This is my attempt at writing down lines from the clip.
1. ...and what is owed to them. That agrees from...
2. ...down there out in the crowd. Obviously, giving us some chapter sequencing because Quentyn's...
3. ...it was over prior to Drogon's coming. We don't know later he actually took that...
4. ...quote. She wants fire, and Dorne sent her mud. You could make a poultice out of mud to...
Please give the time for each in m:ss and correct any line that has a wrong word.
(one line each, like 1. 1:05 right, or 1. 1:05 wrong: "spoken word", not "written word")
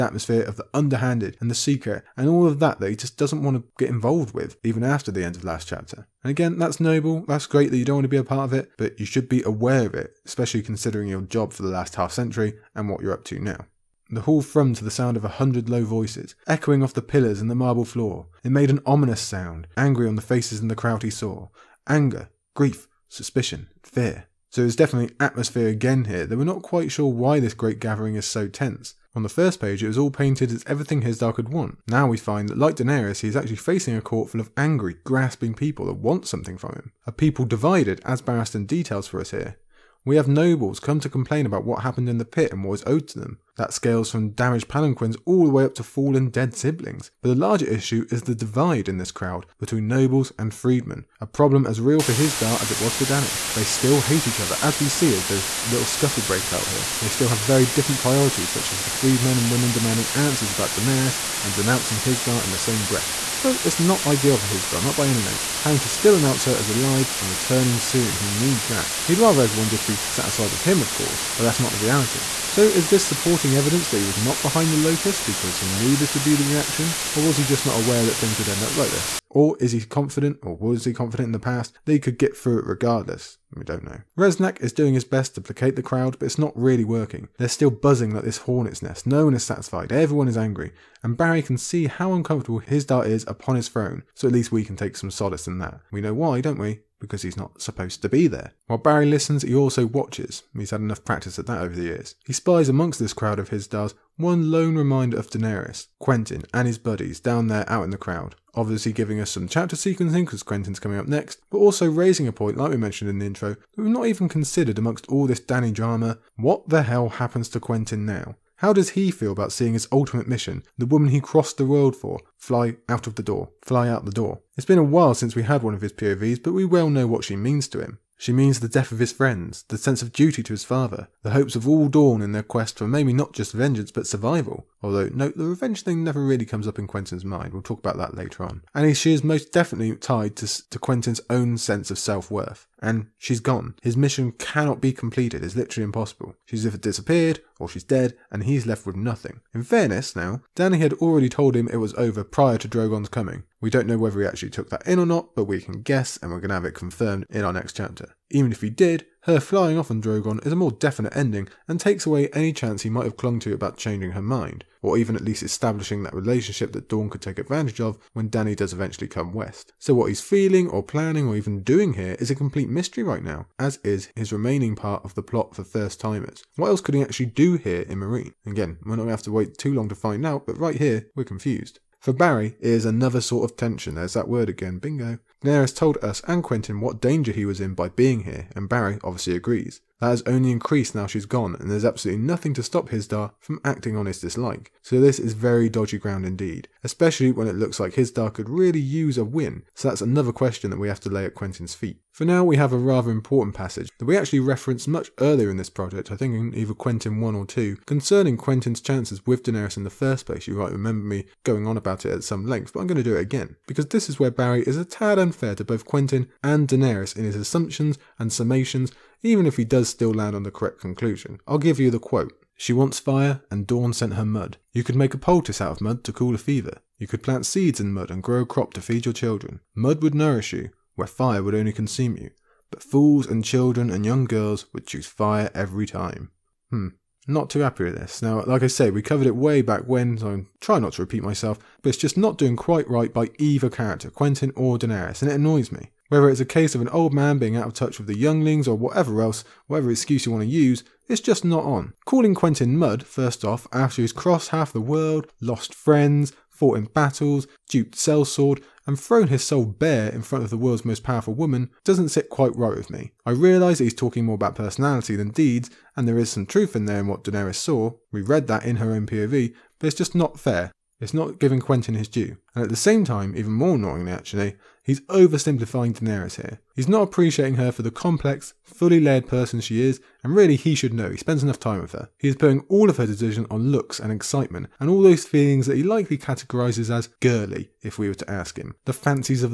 1. 0:42 wrong: "scales", not "agrees"
2. 1:47 right
3. 2:31 wrong: "whether", not "later"
4. 3:41 right.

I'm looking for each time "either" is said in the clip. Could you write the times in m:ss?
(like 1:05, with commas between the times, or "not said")
2:26, 3:26, 4:03.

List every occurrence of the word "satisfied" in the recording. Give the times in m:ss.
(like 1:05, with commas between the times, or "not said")
1:10, 1:29.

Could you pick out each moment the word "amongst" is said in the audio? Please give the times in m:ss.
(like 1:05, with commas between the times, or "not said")
1:42, 1:54.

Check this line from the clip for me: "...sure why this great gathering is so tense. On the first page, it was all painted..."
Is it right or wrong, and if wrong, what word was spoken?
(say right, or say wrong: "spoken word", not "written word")
right.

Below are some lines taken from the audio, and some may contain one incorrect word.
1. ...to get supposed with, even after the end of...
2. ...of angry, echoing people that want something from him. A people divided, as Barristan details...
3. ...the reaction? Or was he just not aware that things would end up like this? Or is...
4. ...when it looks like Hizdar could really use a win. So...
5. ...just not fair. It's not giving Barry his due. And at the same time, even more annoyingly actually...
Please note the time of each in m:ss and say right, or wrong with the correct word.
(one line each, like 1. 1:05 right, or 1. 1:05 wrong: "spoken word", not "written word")
1. 0:03 wrong: "involved", not "supposed"
2. 0:34 wrong: "grasping", not "echoing"
3. 1:16 right
4. 3:17 right
5. 4:29 wrong: "Quentyn", not "Barry".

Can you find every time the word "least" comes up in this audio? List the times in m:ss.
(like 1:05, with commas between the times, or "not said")
1:34, 2:45.